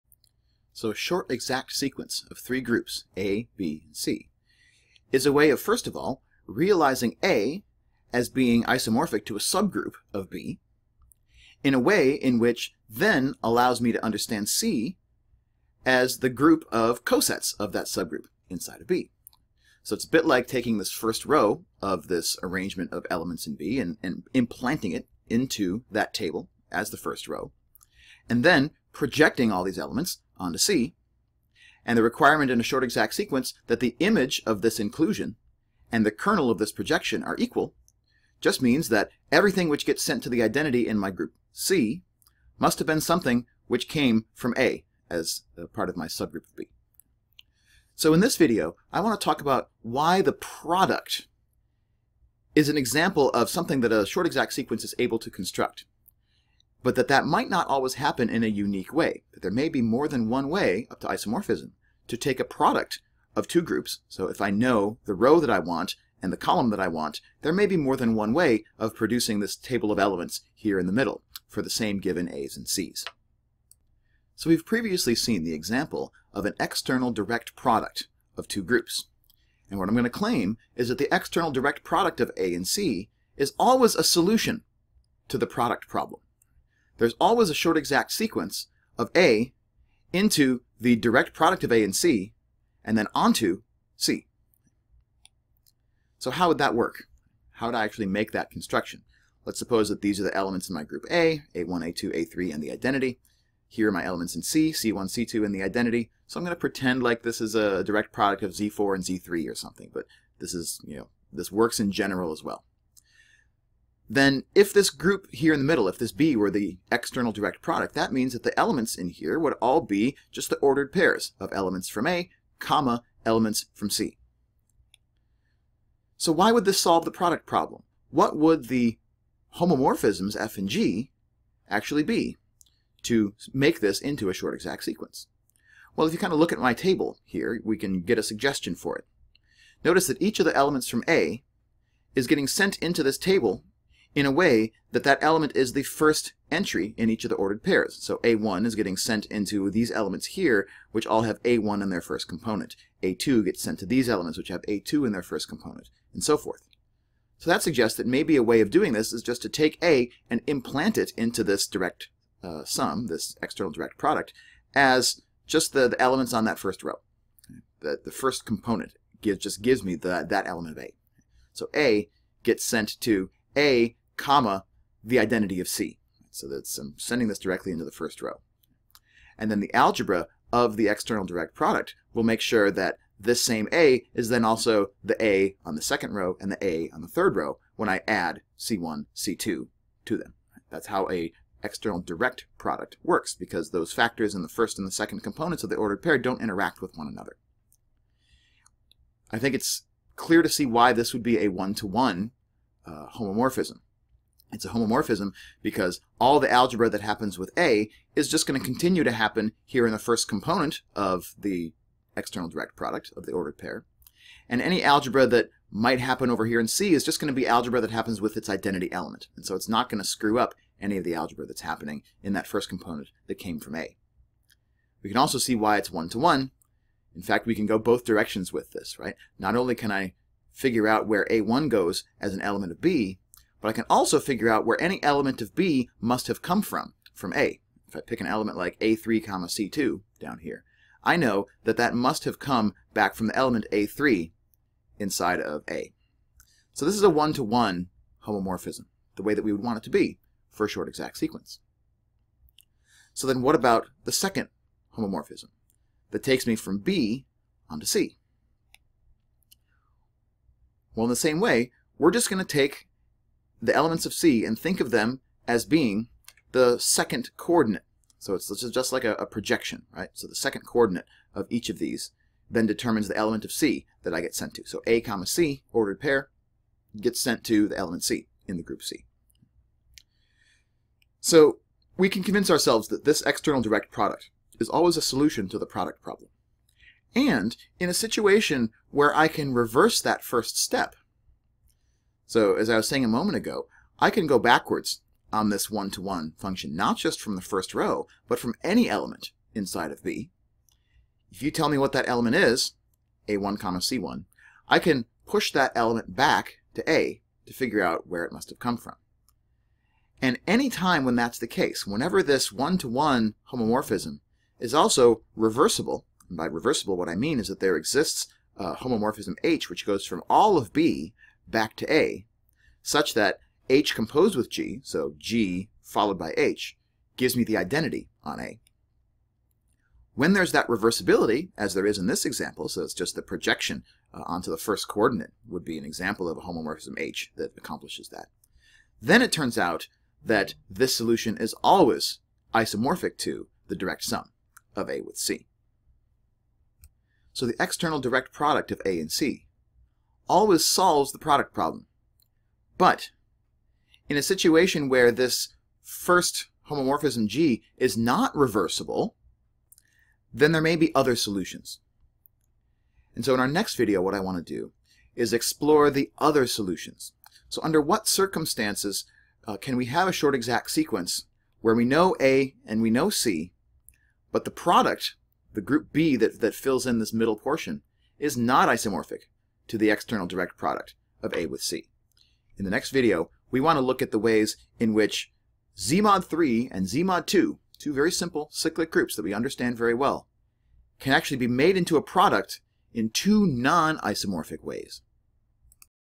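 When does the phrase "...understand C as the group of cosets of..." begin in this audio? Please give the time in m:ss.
0:14.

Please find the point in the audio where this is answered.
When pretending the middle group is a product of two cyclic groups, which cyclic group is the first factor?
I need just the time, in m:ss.
1:48.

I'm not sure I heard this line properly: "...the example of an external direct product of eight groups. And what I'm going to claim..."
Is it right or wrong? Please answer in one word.
wrong.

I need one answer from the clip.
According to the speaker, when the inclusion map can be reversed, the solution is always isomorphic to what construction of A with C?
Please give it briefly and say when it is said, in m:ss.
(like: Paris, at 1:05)
the direct sum, at 5:43.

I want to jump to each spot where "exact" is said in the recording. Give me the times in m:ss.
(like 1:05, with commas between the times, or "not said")
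0:01, 0:32, 0:54, 1:27, 2:14, 4:10, 6:10.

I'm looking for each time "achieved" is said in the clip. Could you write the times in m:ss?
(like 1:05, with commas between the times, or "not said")
not said.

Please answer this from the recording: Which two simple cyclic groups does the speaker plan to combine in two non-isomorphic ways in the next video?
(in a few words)
Z mod 3 and Z mod 2.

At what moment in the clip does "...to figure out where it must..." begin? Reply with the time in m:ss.
5:07.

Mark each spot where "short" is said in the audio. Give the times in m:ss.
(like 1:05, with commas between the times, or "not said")
0:00, 0:32, 0:54, 1:27, 2:14, 4:10, 6:10.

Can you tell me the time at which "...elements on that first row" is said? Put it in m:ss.
2:46.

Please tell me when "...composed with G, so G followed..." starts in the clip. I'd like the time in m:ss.
5:23.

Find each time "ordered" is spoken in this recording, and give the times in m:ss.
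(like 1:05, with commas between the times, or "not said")
2:00, 2:27, 3:15, 3:33, 4:35.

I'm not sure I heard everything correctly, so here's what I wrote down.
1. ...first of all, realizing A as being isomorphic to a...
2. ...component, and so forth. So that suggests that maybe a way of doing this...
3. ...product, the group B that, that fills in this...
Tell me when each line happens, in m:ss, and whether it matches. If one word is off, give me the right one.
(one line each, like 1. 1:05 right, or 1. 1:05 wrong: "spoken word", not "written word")
1. 0:05 right
2. 2:35 right
3. 6:14 right.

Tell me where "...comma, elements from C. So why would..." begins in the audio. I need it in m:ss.
2:02.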